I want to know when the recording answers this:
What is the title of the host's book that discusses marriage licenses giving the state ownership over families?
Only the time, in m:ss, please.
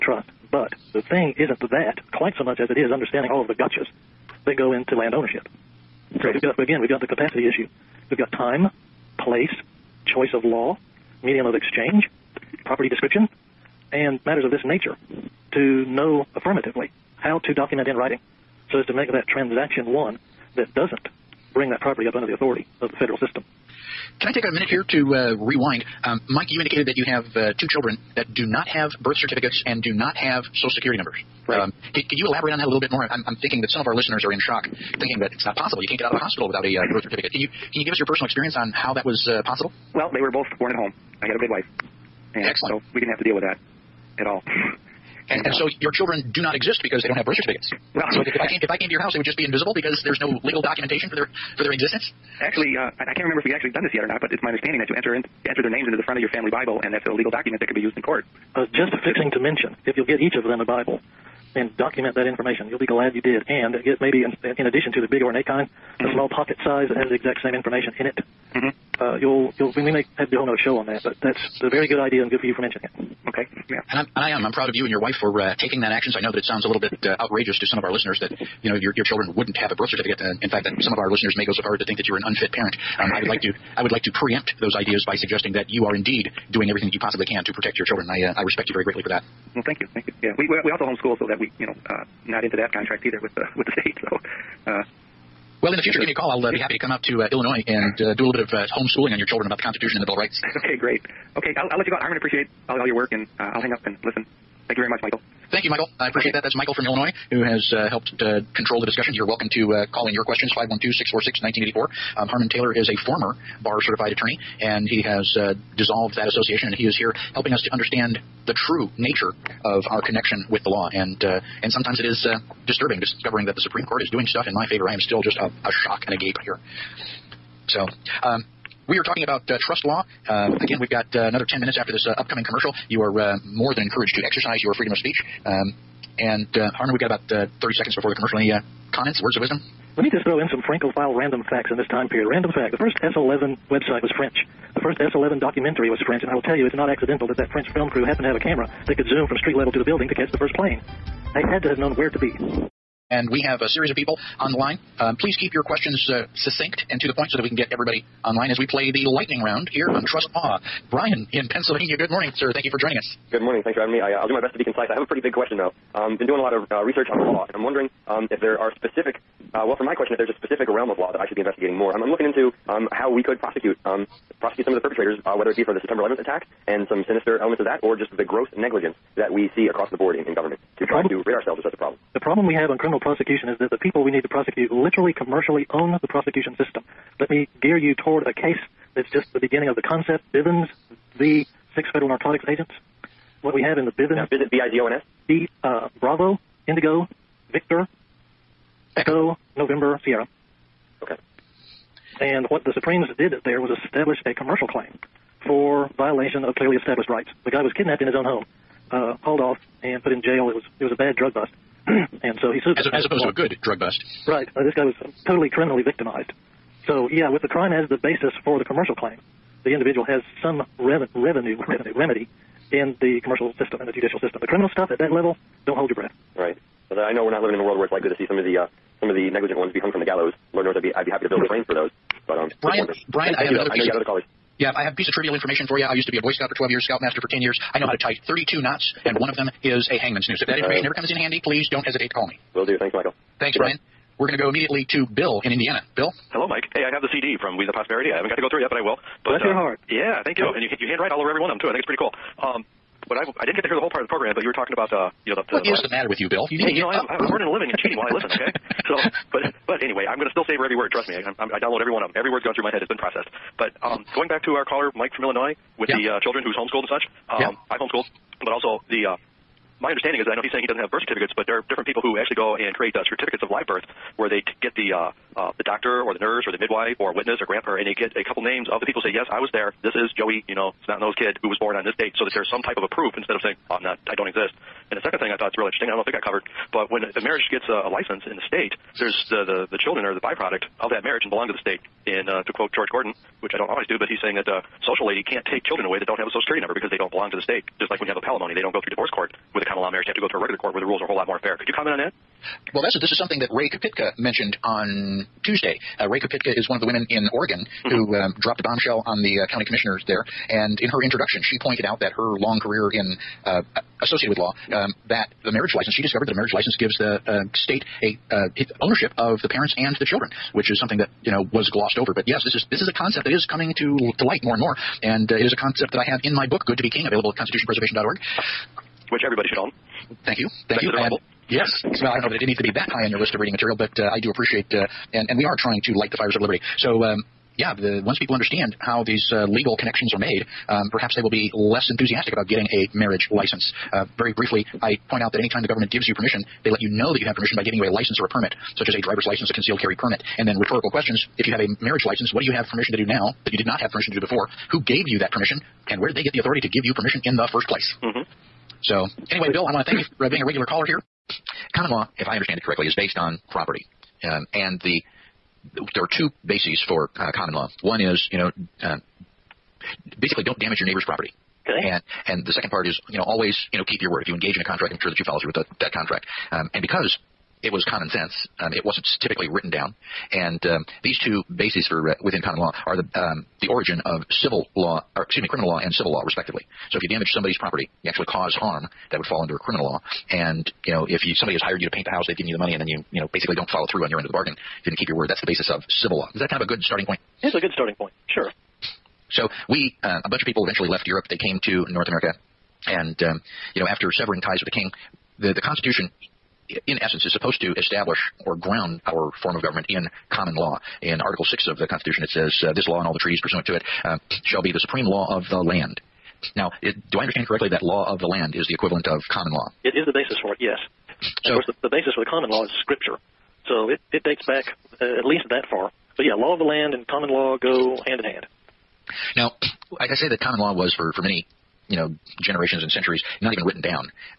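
5:26.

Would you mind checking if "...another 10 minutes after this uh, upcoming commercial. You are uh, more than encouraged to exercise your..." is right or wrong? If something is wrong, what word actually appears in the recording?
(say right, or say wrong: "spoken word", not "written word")
right.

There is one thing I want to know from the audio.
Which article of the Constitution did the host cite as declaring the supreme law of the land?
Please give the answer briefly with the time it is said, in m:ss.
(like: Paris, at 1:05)
Article 6, at 6:51.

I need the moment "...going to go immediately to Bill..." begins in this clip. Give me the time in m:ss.
4:04.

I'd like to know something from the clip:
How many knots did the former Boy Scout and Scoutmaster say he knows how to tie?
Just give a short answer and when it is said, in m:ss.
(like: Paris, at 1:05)
32, at 3:58.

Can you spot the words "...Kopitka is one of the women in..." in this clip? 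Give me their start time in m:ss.
5:06.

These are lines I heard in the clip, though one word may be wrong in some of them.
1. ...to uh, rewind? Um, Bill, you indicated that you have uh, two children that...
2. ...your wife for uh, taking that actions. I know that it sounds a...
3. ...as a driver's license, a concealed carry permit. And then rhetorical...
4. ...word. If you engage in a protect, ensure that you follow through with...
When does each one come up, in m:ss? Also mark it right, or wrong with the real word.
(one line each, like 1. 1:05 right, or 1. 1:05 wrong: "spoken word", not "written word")
1. 0:24 wrong: "Mike", not "Bill"
2. 1:14 right
3. 5:48 right
4. 6:14 wrong: "contract", not "protect".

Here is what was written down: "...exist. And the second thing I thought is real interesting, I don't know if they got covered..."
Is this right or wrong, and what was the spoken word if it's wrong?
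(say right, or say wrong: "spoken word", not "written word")
right.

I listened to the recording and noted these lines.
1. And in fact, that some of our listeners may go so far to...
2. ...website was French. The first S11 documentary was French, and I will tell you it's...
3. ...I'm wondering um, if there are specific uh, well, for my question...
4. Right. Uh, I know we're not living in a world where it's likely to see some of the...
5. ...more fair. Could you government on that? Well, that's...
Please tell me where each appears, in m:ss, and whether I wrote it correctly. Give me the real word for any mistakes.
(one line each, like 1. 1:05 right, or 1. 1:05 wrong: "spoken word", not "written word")
1. 1:20 right
2. 2:23 right
3. 2:47 right
4. 3:46 right
5. 5:01 wrong: "comment", not "government".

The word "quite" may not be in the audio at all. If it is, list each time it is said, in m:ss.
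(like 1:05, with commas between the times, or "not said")
0:02.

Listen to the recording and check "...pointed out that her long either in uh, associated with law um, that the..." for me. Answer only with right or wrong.
wrong.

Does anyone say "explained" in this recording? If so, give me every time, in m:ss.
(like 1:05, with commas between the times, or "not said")
not said.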